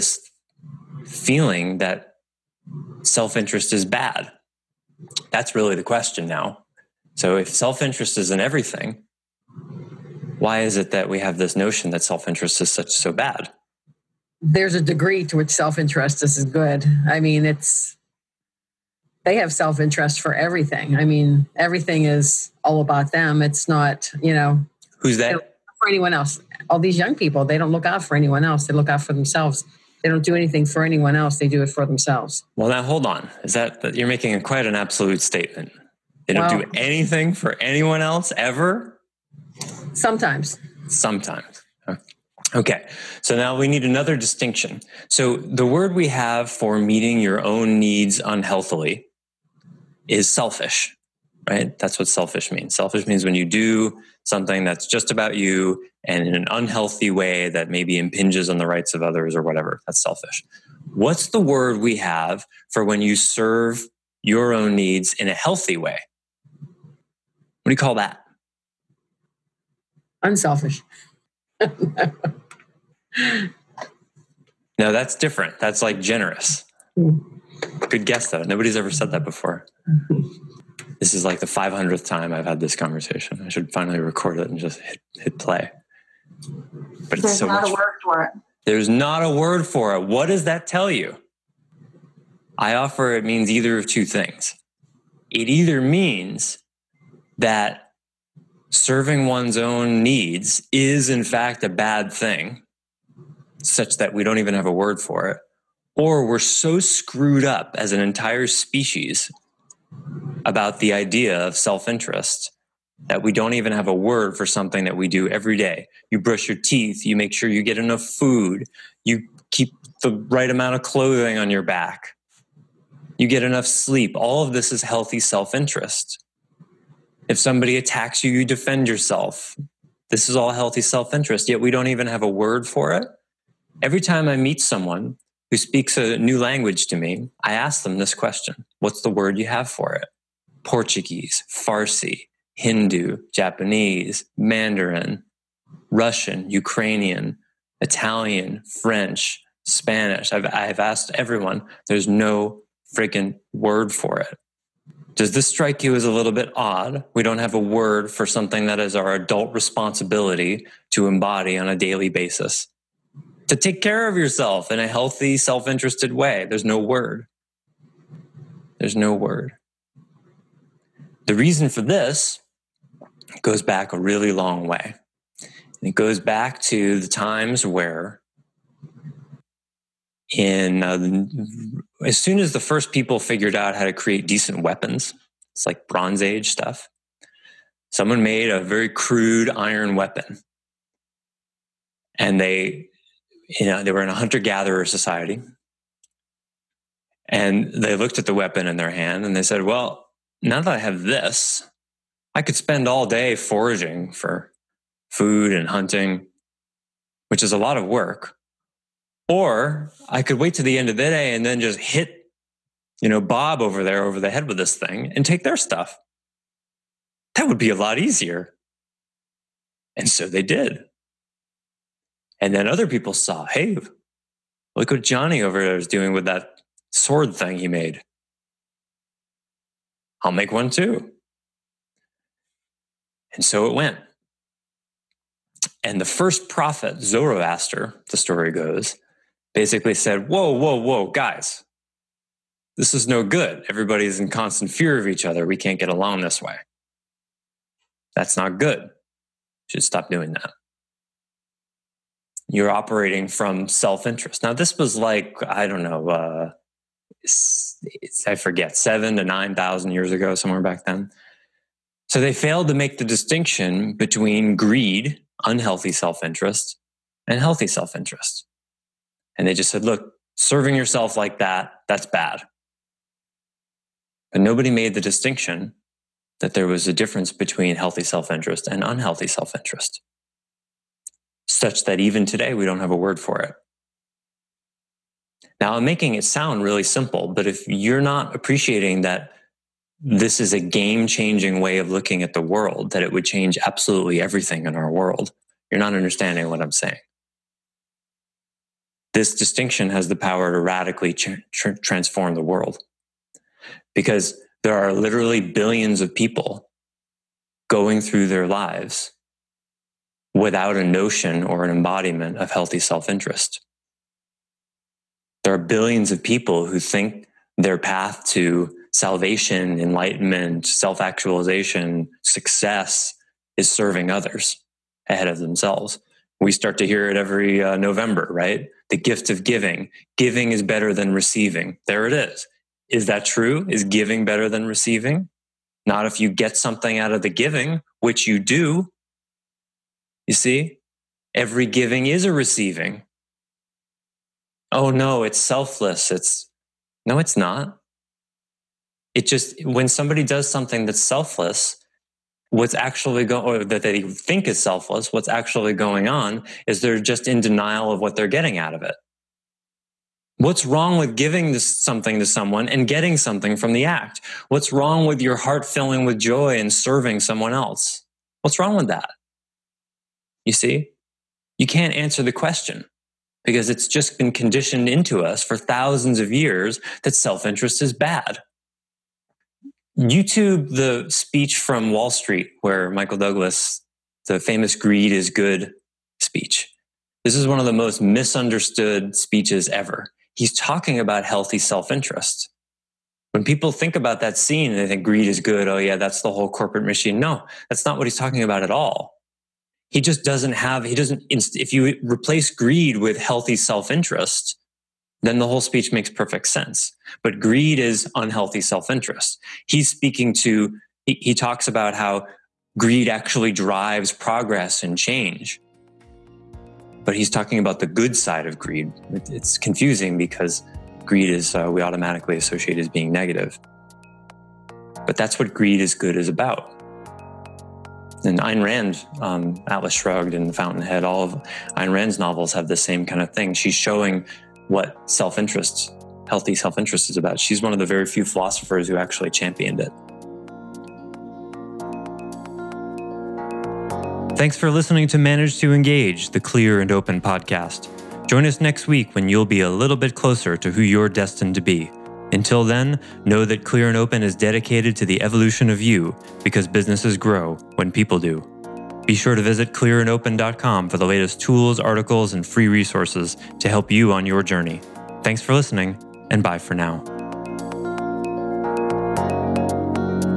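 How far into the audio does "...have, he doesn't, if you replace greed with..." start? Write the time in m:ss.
6:40.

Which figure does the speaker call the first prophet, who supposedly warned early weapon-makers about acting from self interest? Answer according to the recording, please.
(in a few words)
Zoroaster.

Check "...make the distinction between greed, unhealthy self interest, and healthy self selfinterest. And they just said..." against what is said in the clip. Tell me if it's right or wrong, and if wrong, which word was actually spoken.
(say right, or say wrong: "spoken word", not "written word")
wrong: "interest", not "selfinterest".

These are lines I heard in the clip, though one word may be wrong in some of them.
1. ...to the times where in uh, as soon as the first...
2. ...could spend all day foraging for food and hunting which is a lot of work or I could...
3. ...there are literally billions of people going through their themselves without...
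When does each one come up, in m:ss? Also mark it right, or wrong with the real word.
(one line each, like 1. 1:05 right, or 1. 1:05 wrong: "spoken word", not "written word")
1. 2:56 right
2. 3:22 right
3. 5:04 wrong: "lives", not "themselves".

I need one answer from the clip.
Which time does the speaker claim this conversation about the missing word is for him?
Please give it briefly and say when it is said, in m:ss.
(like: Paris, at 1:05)
500th, at 1:21.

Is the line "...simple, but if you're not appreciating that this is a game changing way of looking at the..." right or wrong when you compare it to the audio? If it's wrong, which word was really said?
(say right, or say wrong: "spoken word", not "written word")
right.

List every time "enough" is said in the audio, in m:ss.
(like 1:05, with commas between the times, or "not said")
1:57, 2:03.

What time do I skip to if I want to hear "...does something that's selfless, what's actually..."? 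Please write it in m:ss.
5:50.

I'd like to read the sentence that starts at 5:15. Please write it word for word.
There are billions of people who think their path to salvation, enlightenment, self actualization, success is serving others ahead of themselves.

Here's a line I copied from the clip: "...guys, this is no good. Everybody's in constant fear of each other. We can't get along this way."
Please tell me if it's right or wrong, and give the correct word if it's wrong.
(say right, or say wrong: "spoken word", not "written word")
right.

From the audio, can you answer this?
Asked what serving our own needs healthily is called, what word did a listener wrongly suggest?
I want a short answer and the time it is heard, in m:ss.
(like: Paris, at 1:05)
unselfish, at 1:10.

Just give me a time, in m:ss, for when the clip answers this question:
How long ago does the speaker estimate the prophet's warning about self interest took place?
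4:18.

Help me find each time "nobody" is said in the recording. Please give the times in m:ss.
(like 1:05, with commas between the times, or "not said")
1:18, 4:34.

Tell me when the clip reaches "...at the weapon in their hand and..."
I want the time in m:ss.
3:18.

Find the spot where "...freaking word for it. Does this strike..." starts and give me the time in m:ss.
2:32.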